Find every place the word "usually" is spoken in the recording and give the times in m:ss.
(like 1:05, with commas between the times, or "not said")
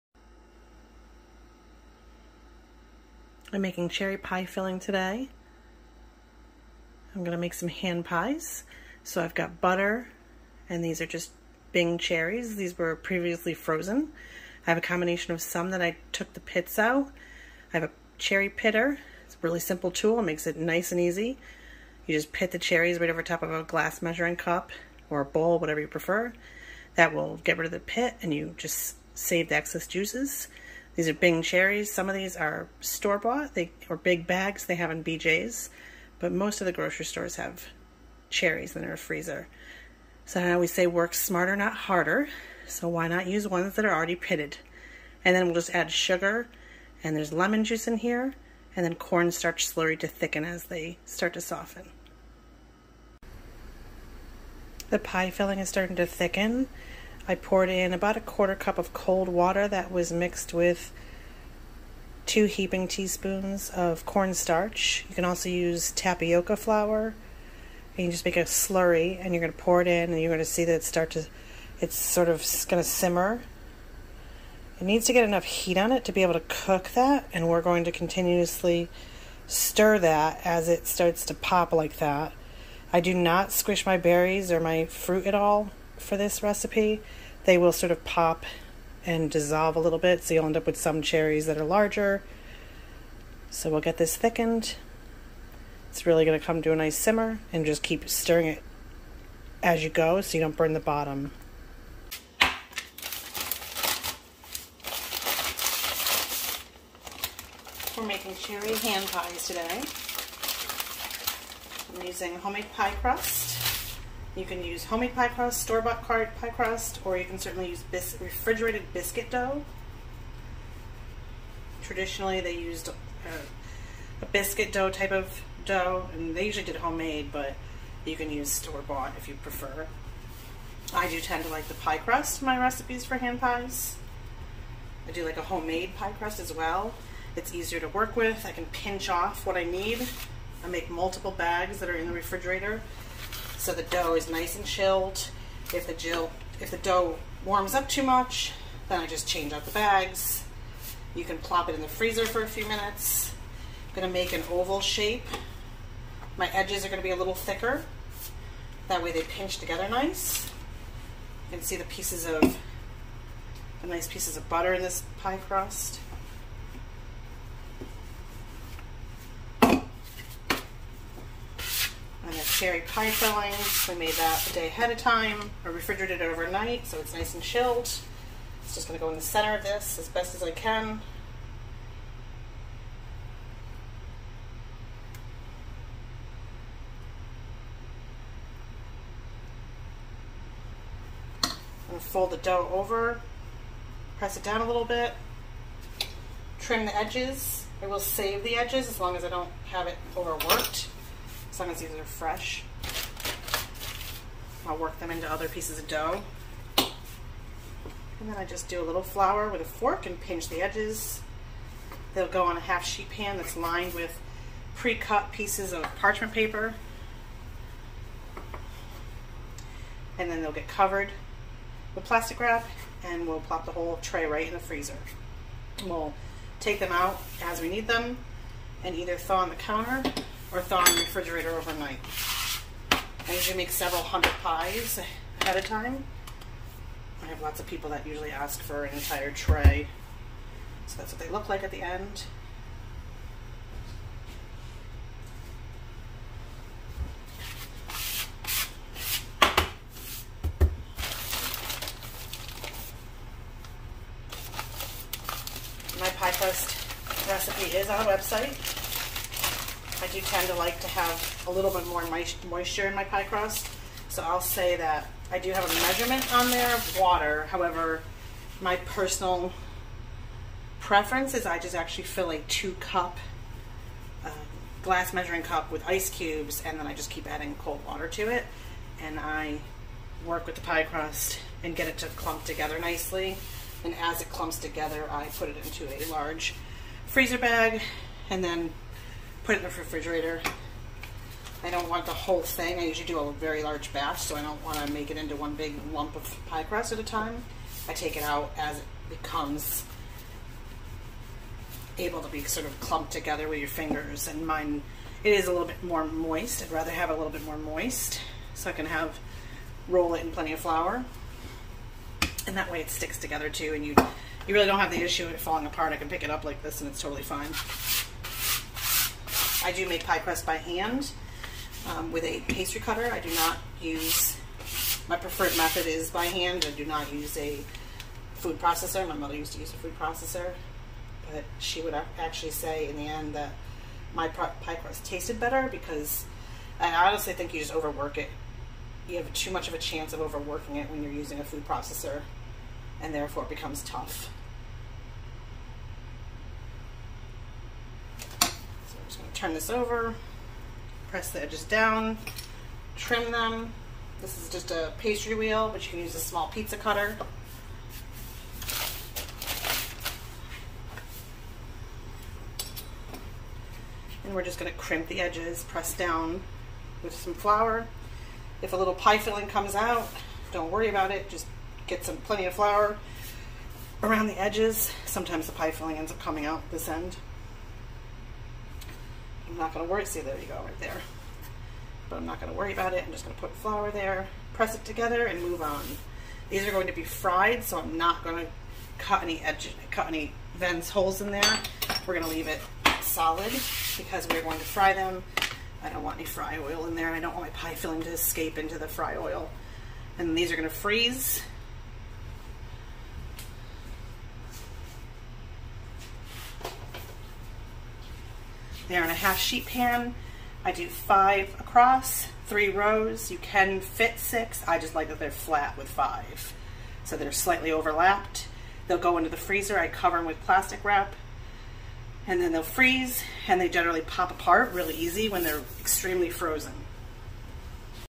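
2:06, 3:53, 3:58, 4:52.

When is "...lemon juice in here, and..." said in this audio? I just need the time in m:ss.
0:47.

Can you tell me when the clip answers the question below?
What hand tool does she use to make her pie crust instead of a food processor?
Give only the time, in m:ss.
5:22.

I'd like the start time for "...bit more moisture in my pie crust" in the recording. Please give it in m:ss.
4:21.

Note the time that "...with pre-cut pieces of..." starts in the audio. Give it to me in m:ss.
3:33.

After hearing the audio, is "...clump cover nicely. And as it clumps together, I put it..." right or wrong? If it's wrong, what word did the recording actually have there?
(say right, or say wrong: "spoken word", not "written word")
wrong: "together", not "cover".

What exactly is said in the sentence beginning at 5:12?
And that way it sticks together too and you, you really don't have the issue of it falling apart.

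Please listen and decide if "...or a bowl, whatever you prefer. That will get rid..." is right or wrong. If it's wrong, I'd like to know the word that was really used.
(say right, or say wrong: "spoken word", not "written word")
right.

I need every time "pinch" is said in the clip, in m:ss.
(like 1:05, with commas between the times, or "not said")
2:18, 2:39, 3:30.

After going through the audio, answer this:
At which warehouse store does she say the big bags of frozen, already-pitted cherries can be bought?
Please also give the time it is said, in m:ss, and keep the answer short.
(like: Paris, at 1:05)
BJ's, at 0:35.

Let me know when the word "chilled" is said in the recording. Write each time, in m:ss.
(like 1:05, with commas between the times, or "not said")
2:24, 2:57.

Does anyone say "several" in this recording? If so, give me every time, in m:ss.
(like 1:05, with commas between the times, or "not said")
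3:53.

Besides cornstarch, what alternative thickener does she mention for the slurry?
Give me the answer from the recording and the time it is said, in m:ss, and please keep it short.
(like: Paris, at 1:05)
Tapioca flour, at 1:05.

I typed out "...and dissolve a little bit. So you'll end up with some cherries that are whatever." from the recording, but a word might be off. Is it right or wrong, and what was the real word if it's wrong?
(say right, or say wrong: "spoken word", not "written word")
wrong: "larger", not "whatever".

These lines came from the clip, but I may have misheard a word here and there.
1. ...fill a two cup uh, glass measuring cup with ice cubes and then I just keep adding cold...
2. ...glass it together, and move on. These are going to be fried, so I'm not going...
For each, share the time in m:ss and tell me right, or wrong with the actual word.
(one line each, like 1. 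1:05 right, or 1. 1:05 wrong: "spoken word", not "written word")
1. 4:32 right
2. 6:24 wrong: "press", not "glass".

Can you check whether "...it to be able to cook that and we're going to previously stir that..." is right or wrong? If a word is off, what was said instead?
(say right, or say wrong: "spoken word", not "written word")
wrong: "continuously", not "previously".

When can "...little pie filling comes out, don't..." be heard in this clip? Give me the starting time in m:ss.
6:08.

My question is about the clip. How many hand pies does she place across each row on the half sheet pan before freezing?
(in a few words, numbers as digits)
5.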